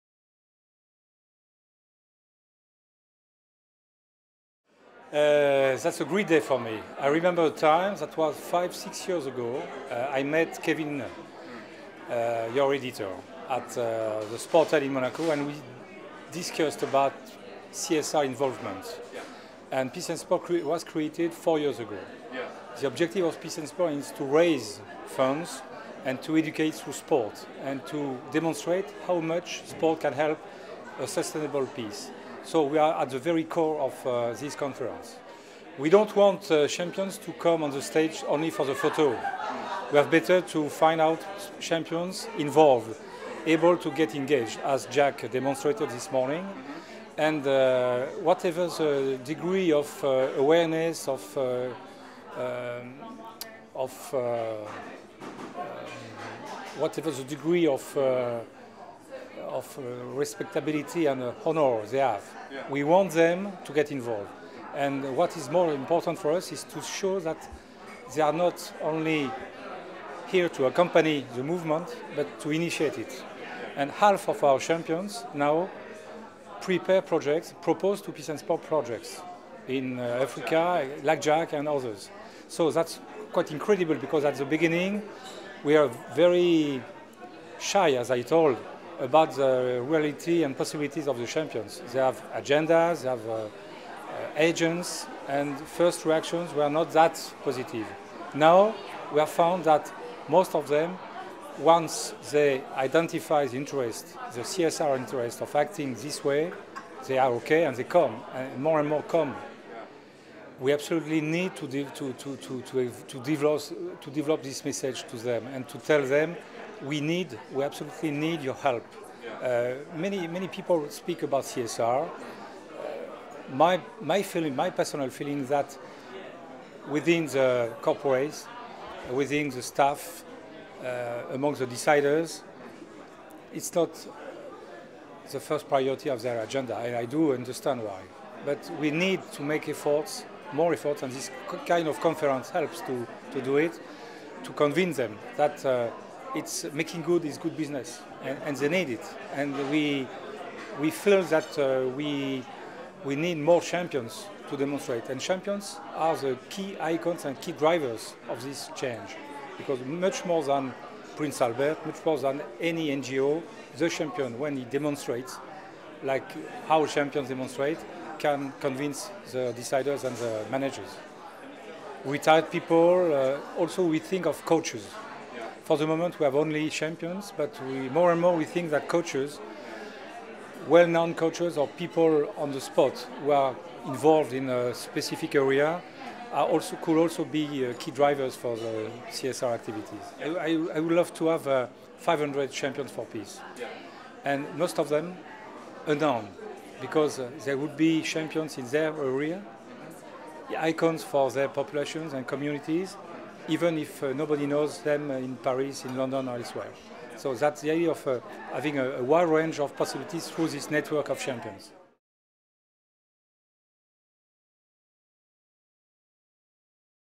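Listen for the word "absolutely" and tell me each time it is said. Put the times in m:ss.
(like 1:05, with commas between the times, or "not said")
1:50, 1:57.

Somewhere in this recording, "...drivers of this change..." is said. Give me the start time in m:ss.
2:37.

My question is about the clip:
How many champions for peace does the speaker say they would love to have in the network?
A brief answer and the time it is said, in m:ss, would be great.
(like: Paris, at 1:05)
500, at 3:11.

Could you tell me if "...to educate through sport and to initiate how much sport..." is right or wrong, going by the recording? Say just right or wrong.
wrong.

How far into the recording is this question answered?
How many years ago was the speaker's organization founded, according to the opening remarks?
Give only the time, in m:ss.
0:21.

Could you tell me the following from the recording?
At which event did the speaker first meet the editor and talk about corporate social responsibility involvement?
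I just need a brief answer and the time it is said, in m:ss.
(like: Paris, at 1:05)
Sportel in Monaco, at 0:14.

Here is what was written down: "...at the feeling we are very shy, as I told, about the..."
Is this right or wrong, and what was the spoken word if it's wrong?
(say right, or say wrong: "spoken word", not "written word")
wrong: "beginning", not "feeling".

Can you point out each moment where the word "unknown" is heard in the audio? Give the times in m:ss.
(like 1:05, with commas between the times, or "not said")
3:15.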